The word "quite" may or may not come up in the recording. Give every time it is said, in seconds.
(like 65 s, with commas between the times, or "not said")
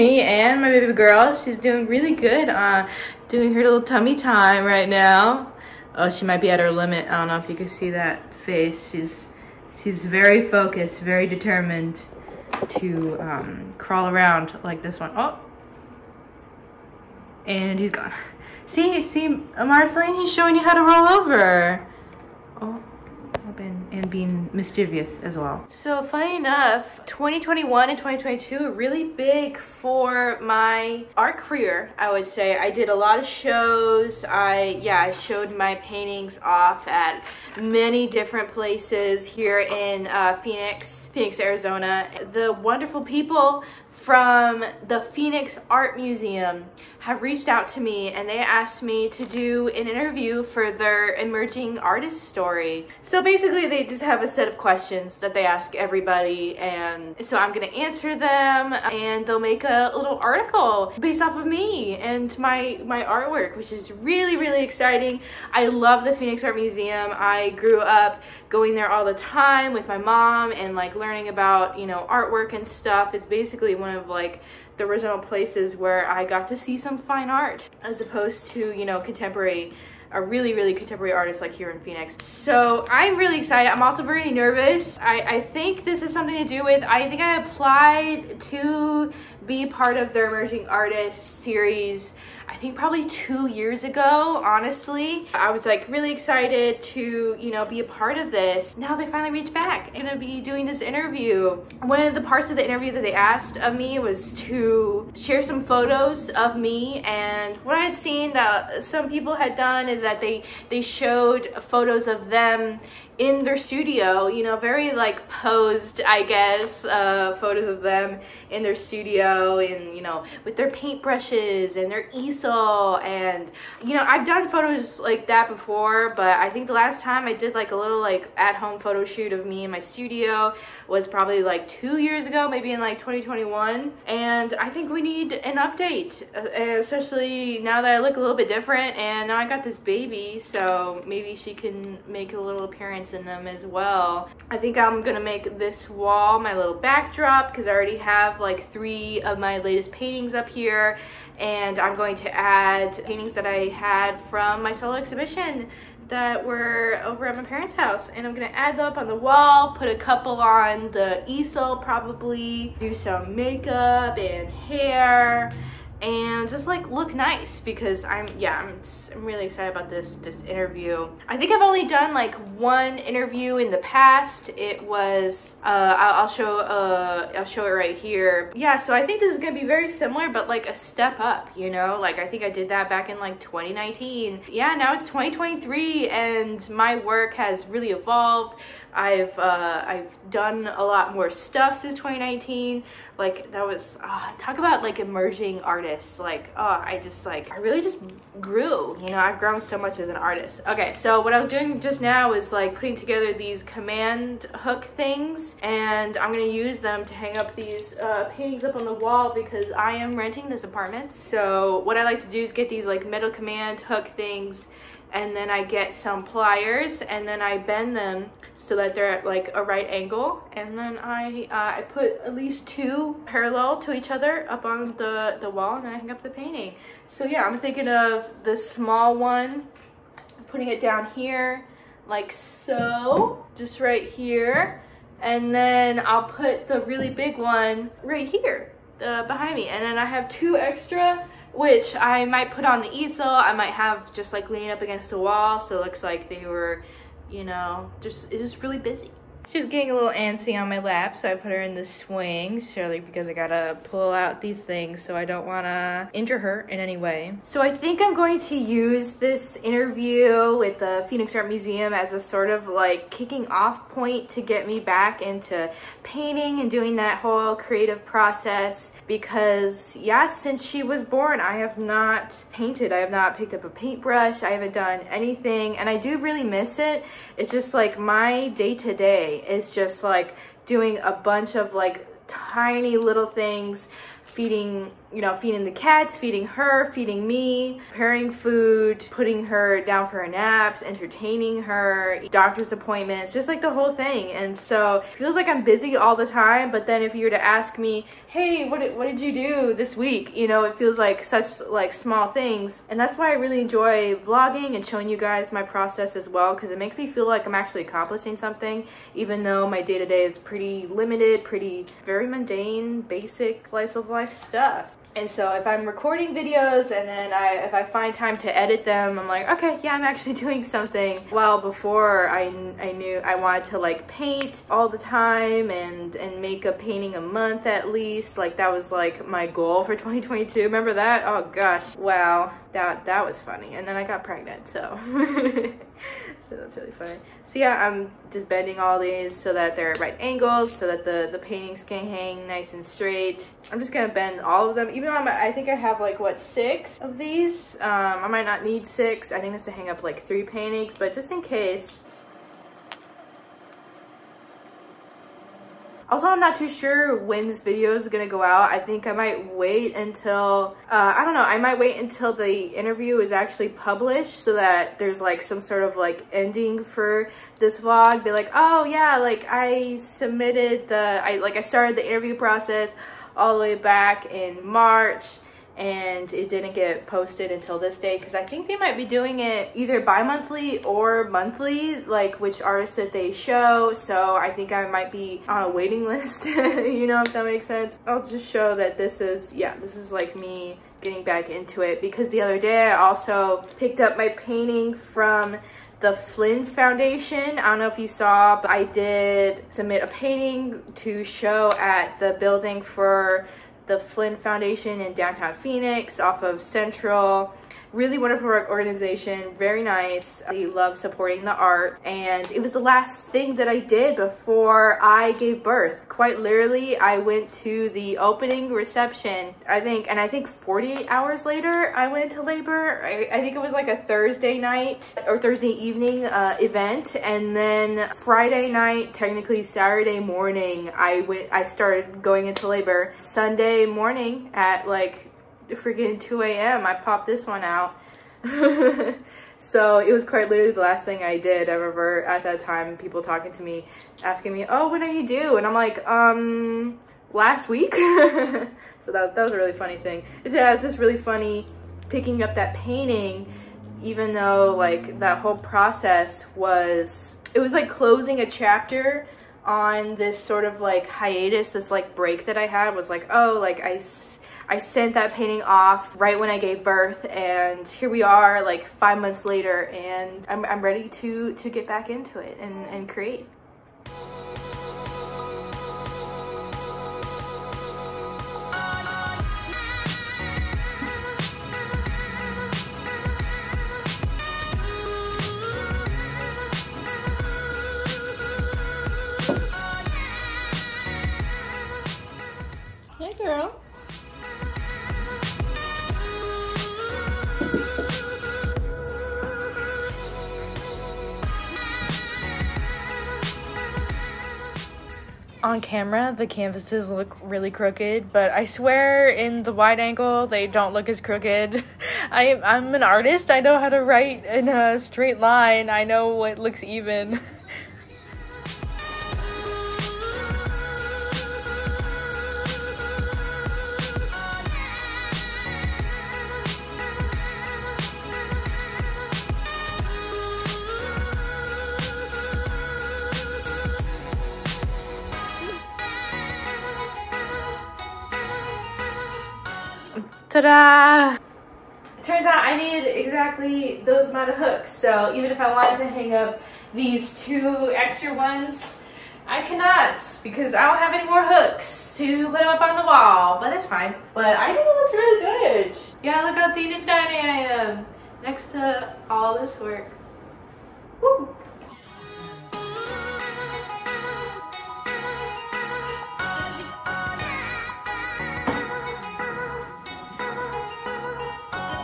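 416 s, 440 s.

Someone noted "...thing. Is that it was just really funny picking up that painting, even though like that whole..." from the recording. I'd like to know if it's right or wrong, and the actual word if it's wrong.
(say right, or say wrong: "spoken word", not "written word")
right.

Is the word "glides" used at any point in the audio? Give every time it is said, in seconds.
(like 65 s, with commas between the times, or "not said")
not said.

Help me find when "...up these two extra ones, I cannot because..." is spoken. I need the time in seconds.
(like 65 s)
546 s.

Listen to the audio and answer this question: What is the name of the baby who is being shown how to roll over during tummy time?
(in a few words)
Marceline.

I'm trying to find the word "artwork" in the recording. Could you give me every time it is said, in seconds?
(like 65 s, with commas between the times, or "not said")
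63 s, 72 s.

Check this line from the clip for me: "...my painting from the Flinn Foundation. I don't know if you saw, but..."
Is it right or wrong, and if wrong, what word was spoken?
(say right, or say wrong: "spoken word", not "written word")
right.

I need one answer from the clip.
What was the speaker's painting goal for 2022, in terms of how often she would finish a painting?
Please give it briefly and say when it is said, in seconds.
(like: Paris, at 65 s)
a painting a month, at 326 s.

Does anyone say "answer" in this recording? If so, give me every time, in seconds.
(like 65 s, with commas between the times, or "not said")
57 s.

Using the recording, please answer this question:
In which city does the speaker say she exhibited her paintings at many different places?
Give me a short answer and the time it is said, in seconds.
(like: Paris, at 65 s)
Phoenix, Arizona, at 41 s.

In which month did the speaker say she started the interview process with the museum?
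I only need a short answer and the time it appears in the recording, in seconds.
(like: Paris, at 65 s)
March, at 374 s.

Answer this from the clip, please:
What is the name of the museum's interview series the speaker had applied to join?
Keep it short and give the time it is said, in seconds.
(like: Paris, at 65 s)
emerging artist story, at 51 s.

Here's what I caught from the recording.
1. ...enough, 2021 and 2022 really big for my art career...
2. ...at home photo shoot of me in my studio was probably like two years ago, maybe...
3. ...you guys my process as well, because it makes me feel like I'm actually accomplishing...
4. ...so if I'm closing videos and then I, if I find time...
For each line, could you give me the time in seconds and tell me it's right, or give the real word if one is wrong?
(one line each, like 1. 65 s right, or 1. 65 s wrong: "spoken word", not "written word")
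1. 26 s right
2. 128 s right
3. 305 s right
4. 315 s wrong: "recording", not "closing".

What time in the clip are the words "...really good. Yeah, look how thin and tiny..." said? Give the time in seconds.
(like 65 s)
555 s.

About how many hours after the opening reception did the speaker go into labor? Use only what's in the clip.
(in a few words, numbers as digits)
48.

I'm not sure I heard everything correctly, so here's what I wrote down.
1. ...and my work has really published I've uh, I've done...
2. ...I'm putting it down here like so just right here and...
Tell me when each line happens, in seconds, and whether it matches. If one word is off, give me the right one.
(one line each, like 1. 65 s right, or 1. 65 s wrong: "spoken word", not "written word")
1. 186 s wrong: "evolved", not "published"
2. 230 s right.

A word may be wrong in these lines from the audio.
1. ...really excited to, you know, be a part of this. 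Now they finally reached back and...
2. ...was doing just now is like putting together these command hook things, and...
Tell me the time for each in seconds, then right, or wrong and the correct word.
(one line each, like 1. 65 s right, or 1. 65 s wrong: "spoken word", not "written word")
1. 95 s right
2. 201 s right.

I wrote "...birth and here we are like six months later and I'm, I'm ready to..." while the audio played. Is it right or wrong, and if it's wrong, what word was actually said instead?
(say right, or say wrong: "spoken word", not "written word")
wrong: "five", not "six".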